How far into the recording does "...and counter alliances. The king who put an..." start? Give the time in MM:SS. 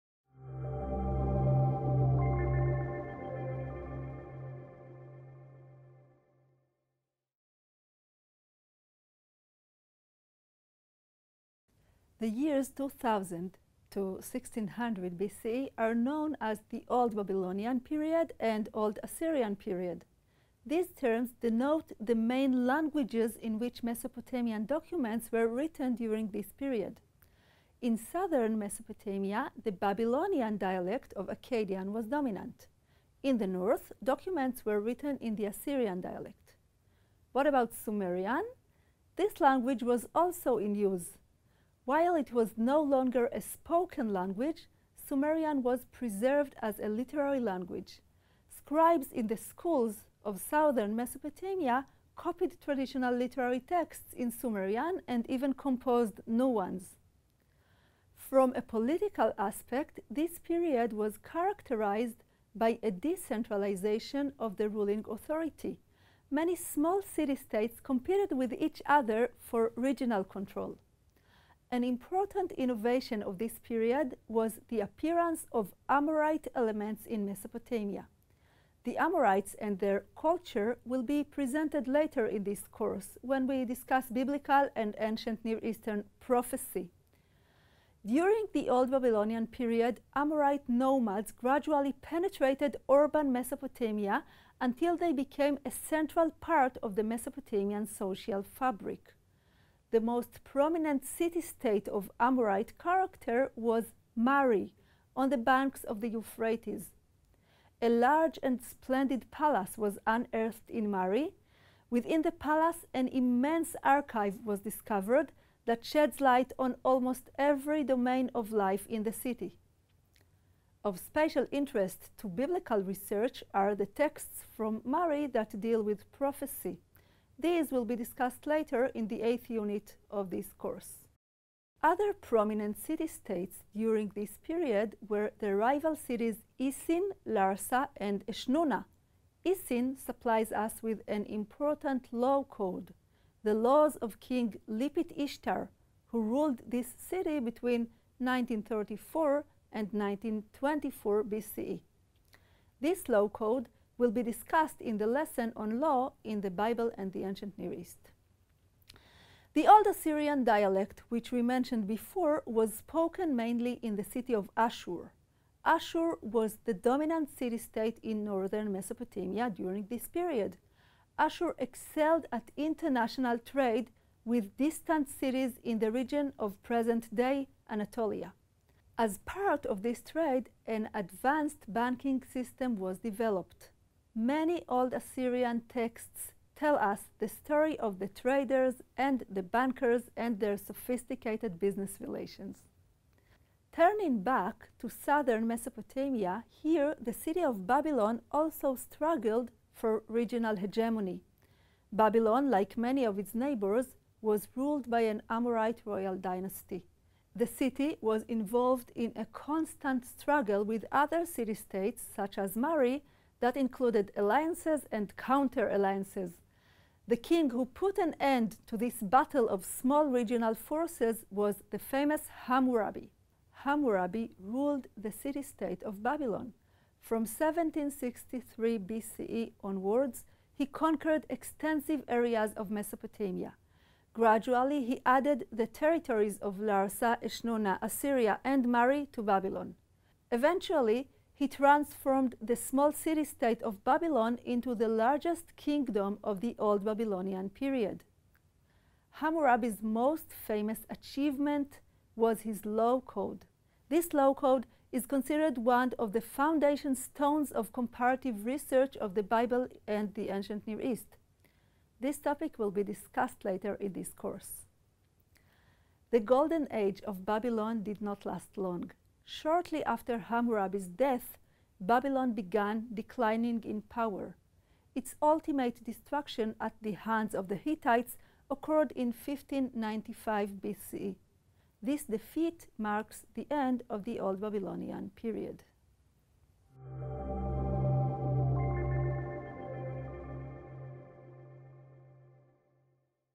03:34.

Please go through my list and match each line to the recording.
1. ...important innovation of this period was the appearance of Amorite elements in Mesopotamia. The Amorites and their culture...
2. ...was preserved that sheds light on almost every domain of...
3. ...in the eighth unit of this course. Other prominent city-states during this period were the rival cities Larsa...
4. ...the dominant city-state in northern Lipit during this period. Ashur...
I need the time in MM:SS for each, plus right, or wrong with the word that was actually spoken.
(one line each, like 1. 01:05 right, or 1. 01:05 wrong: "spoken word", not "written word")
1. 01:11 right
2. 01:54 wrong: "discovered", not "preserved"
3. 02:08 wrong: "Isin", not "Larsa"
4. 02:46 wrong: "Mesopotamia", not "Lipit".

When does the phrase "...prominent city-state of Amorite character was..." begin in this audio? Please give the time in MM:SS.
01:40.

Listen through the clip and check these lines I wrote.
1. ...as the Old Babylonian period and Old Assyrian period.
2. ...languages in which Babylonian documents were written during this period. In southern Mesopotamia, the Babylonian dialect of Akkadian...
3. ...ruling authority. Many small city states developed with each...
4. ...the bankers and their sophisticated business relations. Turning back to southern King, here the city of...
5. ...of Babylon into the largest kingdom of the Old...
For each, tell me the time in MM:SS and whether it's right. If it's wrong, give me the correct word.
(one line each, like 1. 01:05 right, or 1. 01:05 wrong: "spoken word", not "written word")
1. 00:16 right
2. 00:22 wrong: "Mesopotamian", not "Babylonian"
3. 01:04 wrong: "competed", not "developed"
4. 03:09 wrong: "Mesopotamia", not "King"
5. 04:03 right.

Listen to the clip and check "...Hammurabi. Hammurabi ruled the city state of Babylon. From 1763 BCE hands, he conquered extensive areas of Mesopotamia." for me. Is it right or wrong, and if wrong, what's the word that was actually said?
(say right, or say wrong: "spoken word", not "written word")
wrong: "onwards", not "hands".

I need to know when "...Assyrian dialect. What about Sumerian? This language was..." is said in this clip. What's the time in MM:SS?
00:35.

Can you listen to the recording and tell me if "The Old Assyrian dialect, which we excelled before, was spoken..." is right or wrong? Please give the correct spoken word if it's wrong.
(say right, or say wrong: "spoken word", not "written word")
wrong: "mentioned", not "excelled".